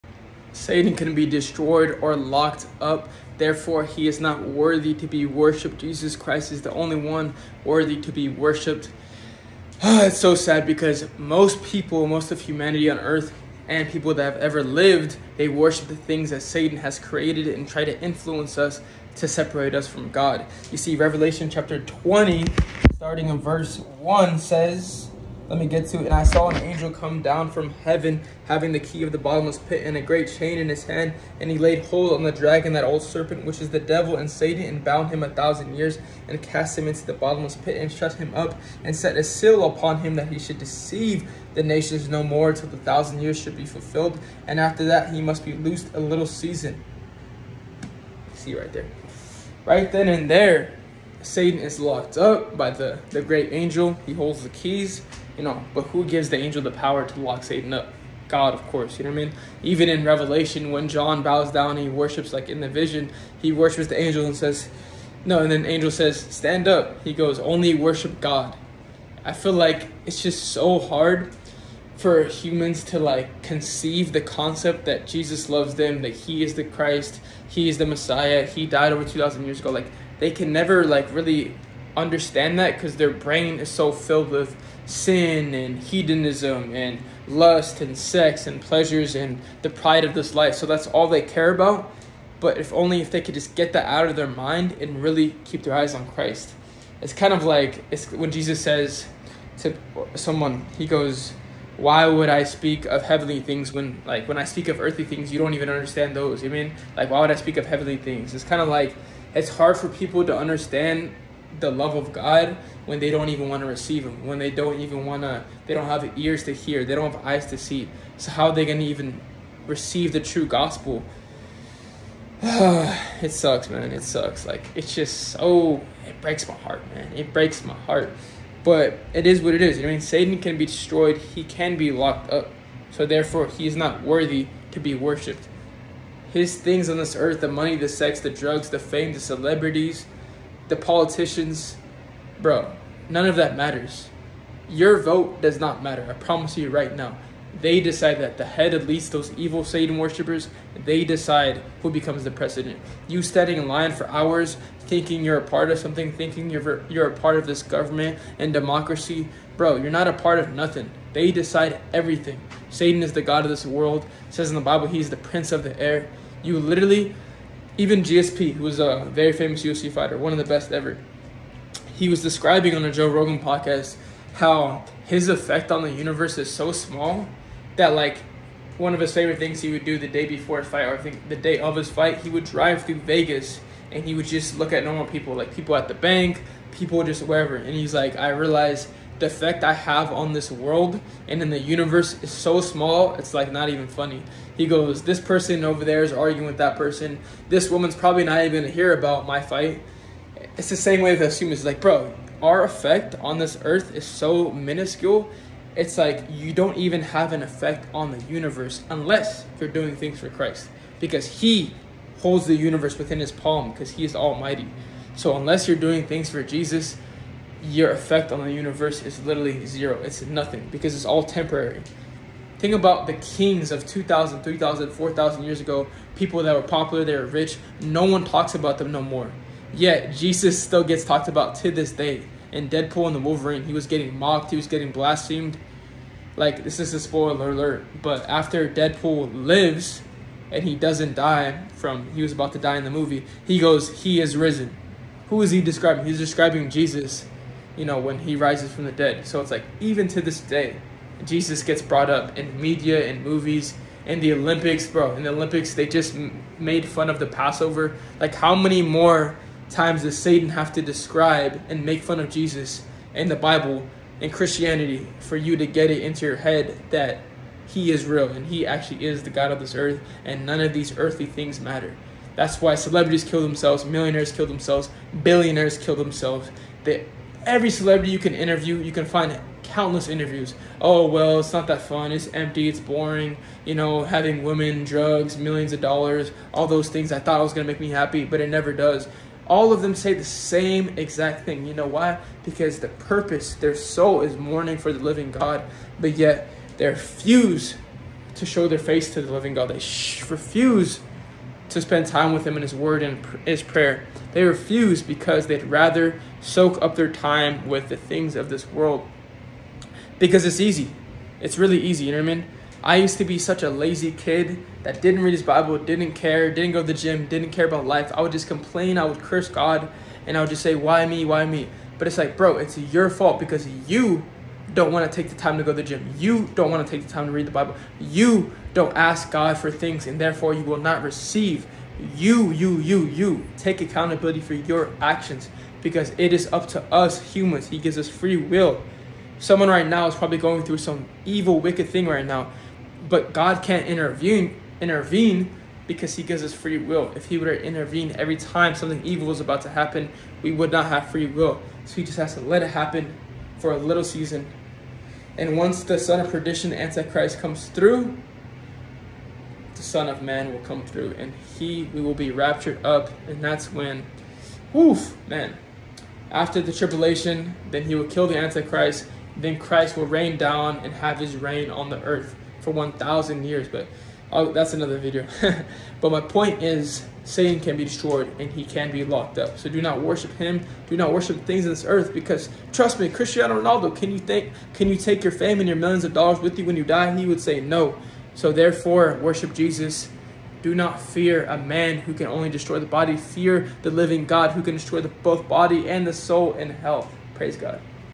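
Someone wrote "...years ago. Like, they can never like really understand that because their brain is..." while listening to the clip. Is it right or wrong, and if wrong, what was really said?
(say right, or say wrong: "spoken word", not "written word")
right.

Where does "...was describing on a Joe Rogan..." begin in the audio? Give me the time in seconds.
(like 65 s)
172 s.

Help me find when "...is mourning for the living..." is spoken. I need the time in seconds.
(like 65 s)
294 s.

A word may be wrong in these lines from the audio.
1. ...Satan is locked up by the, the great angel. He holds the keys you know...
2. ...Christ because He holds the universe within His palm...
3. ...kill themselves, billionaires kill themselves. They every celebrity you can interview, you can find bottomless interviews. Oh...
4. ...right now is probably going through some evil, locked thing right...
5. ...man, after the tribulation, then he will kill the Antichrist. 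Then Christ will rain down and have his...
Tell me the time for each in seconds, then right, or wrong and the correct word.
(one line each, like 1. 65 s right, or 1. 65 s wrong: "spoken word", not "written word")
1. 51 s right
2. 210 s right
3. 274 s wrong: "countless", not "bottomless"
4. 339 s wrong: "wicked", not "locked"
5. 365 s right.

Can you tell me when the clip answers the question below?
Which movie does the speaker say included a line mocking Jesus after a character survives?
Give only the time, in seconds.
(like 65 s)
232 s.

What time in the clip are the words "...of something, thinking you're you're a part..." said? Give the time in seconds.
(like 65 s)
155 s.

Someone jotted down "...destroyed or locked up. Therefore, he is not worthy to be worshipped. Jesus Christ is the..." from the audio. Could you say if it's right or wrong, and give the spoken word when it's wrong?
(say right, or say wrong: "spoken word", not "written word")
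right.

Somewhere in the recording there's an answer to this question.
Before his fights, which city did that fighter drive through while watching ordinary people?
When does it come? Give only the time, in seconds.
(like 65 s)
183 s.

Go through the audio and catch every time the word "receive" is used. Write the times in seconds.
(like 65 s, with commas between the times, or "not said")
113 s, 119 s, 331 s.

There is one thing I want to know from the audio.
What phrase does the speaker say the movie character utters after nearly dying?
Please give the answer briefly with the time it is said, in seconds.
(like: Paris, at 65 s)
He is risen, at 244 s.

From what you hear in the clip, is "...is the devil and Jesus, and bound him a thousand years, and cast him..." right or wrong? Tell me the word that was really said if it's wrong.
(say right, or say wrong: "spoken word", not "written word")
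wrong: "Satan", not "Jesus".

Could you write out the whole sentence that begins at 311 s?
It's really easy, you know what I mean?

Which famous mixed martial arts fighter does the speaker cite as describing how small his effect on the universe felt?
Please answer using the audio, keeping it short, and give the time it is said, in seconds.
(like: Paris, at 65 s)
GSP, at 168 s.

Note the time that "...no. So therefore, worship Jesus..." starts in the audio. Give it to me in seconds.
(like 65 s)
387 s.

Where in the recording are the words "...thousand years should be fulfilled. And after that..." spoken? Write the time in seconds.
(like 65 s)
42 s.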